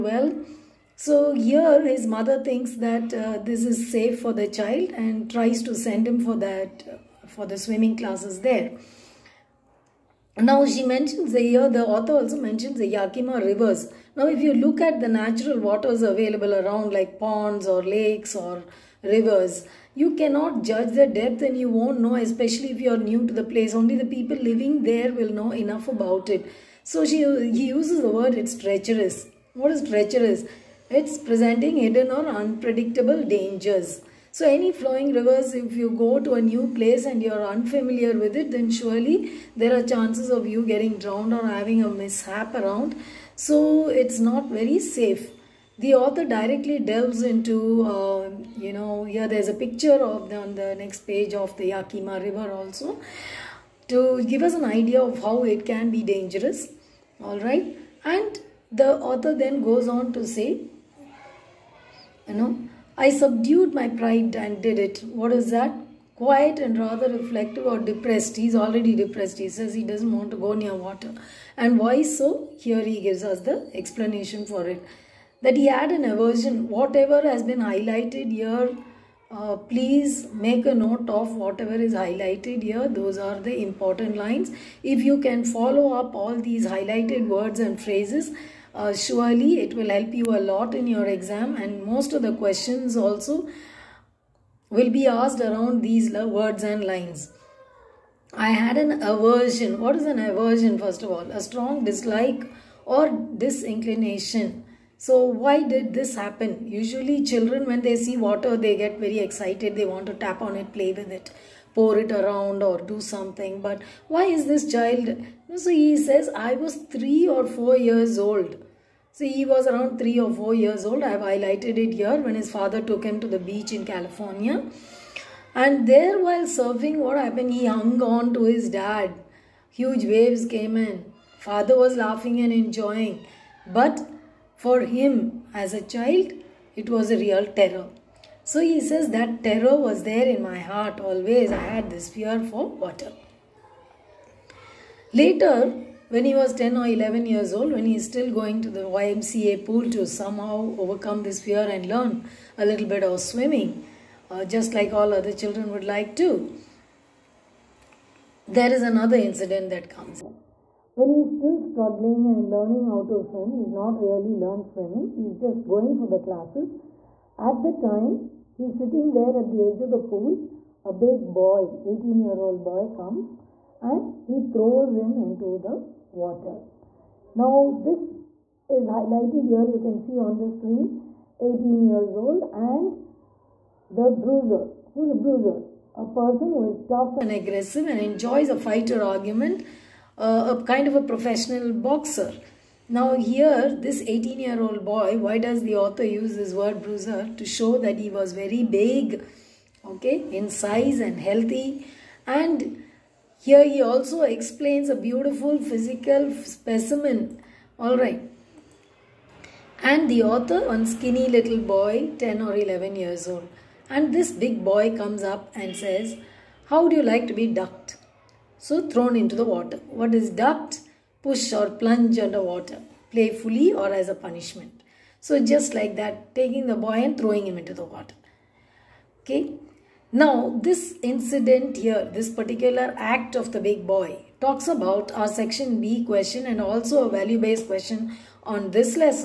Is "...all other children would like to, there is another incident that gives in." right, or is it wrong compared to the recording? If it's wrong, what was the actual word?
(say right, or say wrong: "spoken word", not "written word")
wrong: "comes", not "gives".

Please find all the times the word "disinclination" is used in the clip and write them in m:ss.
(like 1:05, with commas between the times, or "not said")
1:43.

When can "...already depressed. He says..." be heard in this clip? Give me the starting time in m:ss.
1:08.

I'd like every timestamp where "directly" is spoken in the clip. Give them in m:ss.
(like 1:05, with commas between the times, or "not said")
0:46.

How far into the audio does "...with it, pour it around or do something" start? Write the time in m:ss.
1:50.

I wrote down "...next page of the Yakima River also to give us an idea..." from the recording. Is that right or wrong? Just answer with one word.
right.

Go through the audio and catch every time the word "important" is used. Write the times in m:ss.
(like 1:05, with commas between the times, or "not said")
1:23.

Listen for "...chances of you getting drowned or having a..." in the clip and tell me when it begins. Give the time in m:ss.
0:39.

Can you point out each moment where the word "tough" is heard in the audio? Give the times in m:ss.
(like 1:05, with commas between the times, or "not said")
3:06.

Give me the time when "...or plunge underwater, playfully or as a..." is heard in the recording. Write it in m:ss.
3:41.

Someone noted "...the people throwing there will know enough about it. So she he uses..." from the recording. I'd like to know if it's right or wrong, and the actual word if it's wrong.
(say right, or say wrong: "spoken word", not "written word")
wrong: "living", not "throwing".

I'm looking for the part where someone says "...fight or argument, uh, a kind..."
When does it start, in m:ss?
3:08.